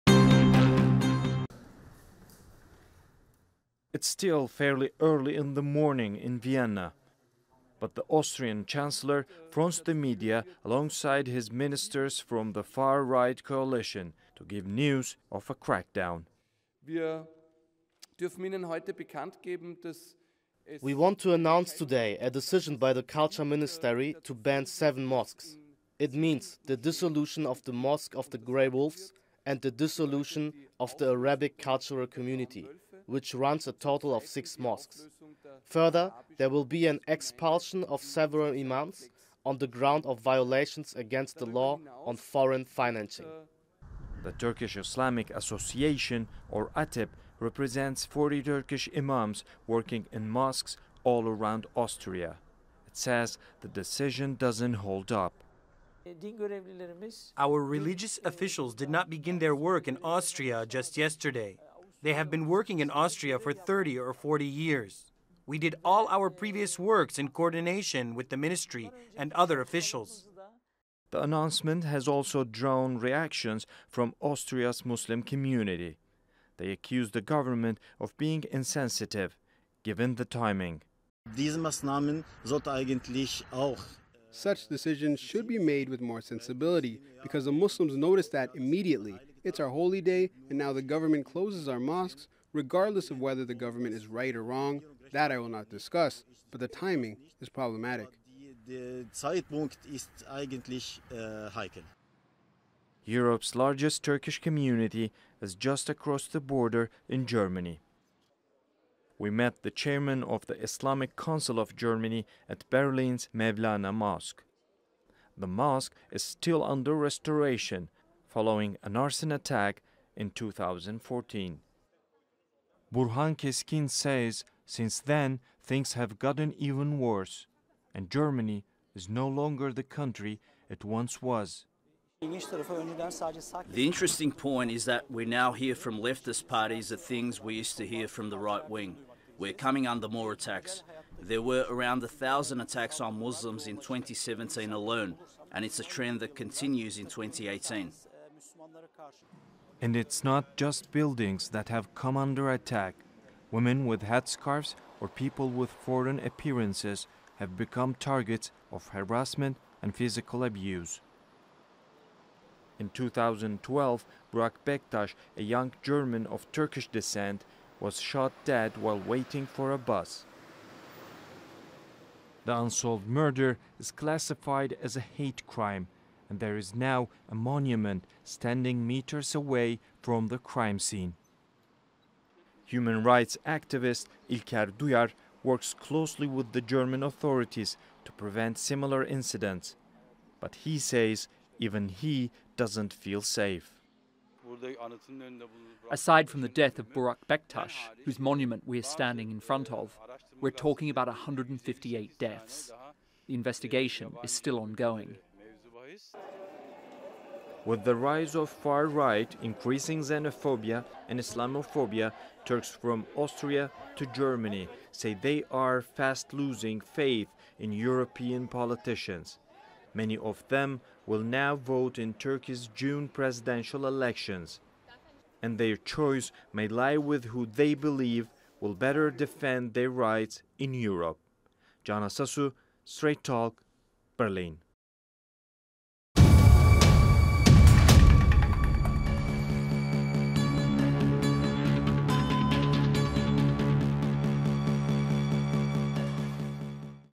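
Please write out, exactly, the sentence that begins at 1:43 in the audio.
Europe's largest Turkish community is just across the border in Germany.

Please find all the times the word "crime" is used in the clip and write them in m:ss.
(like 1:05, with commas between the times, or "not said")
2:55, 3:00.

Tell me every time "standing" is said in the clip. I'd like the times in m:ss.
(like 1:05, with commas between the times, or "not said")
2:58, 3:18.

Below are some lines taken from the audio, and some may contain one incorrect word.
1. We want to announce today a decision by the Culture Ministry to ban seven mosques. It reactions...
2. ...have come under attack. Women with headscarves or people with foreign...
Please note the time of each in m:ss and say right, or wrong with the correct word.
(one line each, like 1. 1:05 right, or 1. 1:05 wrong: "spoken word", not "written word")
1. 0:20 wrong: "means", not "reactions"
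2. 2:31 right.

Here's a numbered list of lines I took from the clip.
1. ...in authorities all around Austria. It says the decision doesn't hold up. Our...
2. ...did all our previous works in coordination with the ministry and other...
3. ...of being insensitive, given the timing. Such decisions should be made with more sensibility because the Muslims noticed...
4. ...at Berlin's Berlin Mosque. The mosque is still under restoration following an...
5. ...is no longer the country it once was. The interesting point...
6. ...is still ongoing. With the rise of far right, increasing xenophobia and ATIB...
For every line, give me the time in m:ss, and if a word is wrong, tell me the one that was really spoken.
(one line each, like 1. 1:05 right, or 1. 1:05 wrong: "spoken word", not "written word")
1. 0:50 wrong: "mosques", not "authorities"
2. 1:05 right
3. 1:17 right
4. 1:52 wrong: "Mevlana", not "Berlin"
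5. 2:08 right
6. 3:24 wrong: "Islamophobia", not "ATIB".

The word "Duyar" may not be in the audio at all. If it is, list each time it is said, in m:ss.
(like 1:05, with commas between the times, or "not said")
3:04.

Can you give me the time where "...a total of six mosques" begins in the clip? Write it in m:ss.
0:33.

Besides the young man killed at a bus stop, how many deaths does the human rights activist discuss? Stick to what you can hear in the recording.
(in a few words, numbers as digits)
158.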